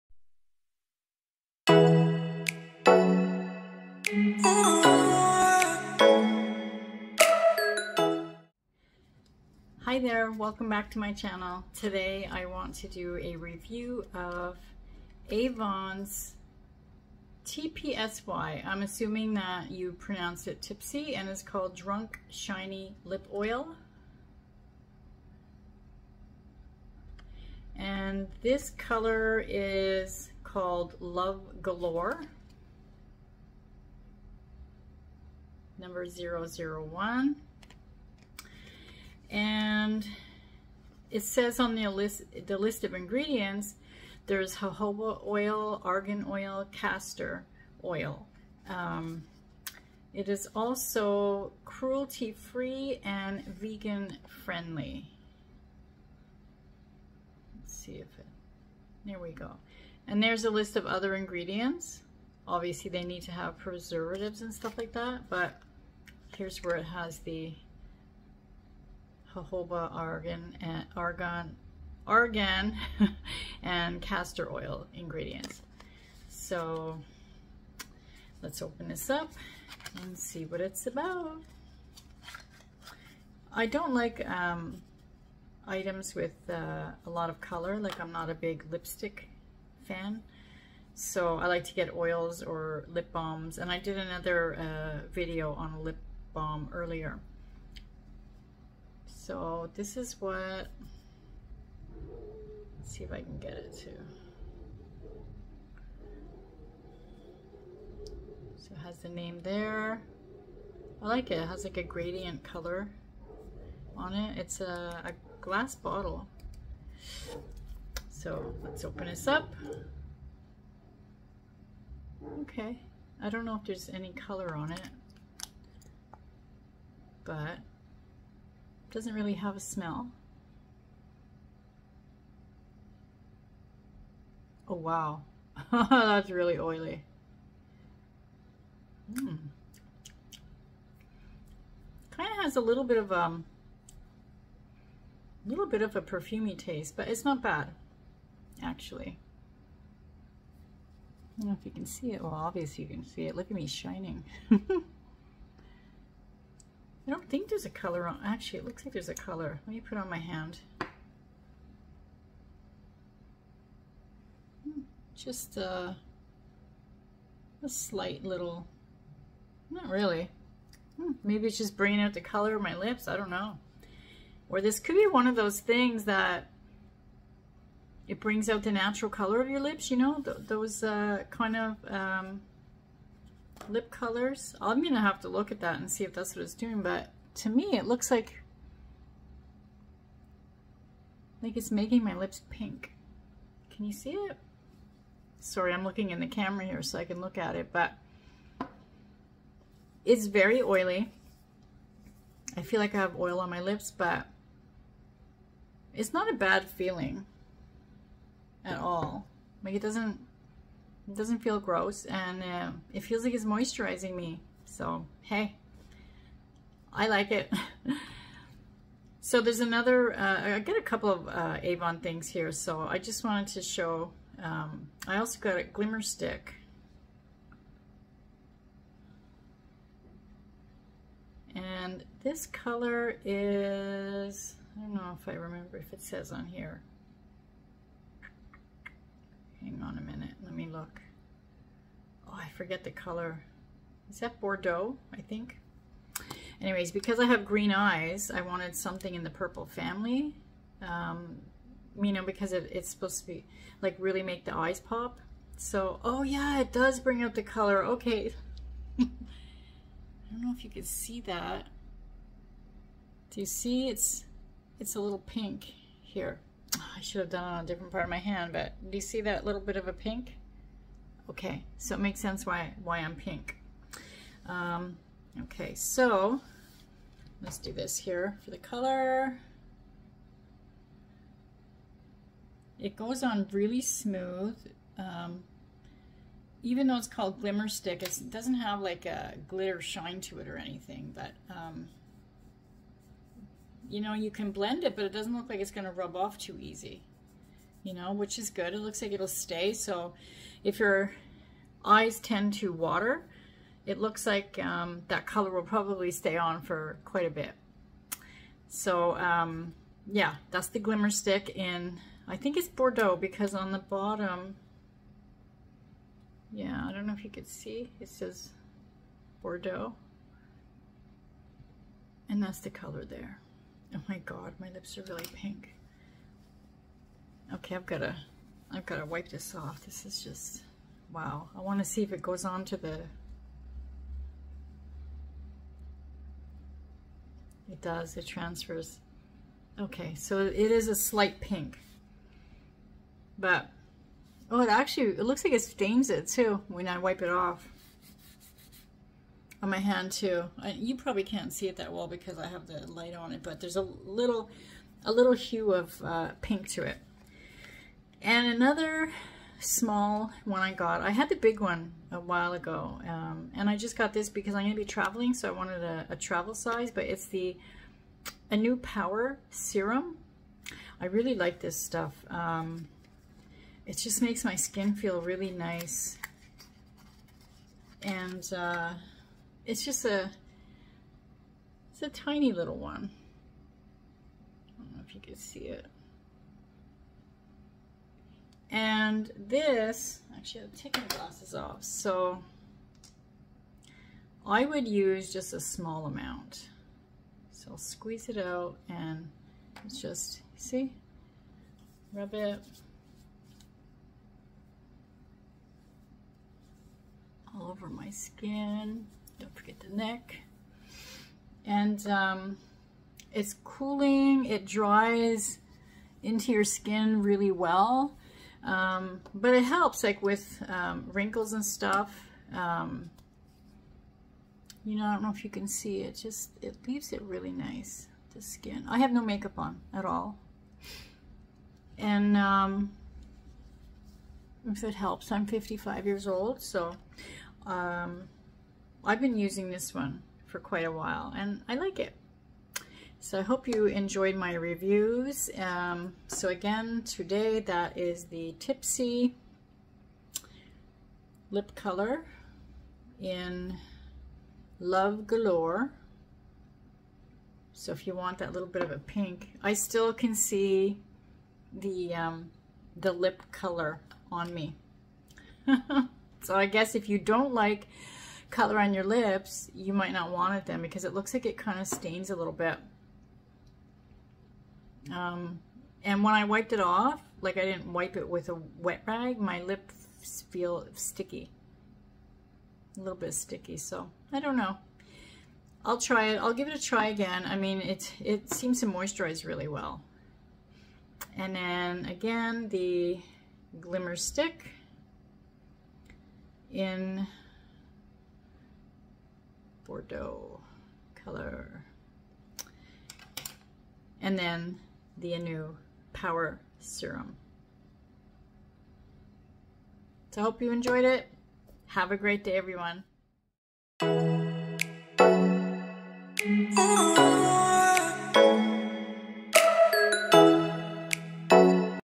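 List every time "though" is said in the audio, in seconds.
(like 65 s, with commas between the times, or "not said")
286 s.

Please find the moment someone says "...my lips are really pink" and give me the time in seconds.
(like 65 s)
324 s.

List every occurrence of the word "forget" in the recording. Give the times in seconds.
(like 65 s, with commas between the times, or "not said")
242 s, 409 s.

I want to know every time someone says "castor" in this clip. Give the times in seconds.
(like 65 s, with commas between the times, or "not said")
46 s, 74 s.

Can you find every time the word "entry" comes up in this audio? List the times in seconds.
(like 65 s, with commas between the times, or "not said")
not said.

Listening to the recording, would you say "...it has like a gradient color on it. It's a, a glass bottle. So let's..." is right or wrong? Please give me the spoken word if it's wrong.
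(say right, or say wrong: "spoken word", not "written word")
right.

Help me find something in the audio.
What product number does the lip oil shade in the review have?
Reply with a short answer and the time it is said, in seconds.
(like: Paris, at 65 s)
001, at 35 s.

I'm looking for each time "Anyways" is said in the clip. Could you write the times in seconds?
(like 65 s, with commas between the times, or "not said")
246 s.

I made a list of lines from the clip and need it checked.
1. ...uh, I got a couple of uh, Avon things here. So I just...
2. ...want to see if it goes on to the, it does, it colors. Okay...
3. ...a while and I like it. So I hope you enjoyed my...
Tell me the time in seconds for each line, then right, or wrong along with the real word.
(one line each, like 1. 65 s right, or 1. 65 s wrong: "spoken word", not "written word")
1. 220 s right
2. 331 s wrong: "transfers", not "colors"
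3. 440 s right.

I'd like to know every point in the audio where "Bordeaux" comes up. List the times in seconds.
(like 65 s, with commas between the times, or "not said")
244 s, 312 s, 319 s, 499 s.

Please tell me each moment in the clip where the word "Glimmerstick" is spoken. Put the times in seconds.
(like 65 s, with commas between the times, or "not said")
225 s, 287 s, 310 s, 493 s.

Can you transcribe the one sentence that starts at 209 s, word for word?
Like it doesn't it doesn't feel gross and uh, it feels like it's moisturizing me.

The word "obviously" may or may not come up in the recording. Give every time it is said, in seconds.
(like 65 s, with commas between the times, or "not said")
62 s, 152 s.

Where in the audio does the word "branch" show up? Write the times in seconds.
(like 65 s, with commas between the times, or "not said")
not said.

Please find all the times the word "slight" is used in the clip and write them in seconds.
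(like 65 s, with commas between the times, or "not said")
167 s, 340 s.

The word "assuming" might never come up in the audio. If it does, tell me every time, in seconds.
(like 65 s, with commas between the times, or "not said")
18 s.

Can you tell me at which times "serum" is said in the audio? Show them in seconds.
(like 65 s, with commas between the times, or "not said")
369 s, 506 s.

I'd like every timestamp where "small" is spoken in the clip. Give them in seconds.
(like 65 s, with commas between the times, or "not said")
359 s, 395 s.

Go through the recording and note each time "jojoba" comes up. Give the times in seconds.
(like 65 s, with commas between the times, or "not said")
44 s, 69 s.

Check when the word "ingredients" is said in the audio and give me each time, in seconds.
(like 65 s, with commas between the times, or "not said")
42 s, 61 s, 74 s.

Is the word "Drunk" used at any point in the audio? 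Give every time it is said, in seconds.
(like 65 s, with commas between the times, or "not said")
21 s.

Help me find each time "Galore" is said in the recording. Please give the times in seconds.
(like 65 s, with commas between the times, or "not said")
31 s, 455 s.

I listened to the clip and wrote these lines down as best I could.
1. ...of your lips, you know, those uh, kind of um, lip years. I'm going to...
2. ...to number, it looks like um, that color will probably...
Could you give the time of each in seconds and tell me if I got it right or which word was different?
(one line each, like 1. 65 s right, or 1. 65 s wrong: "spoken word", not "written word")
1. 179 s wrong: "colors", not "years"
2. 302 s wrong: "water", not "number".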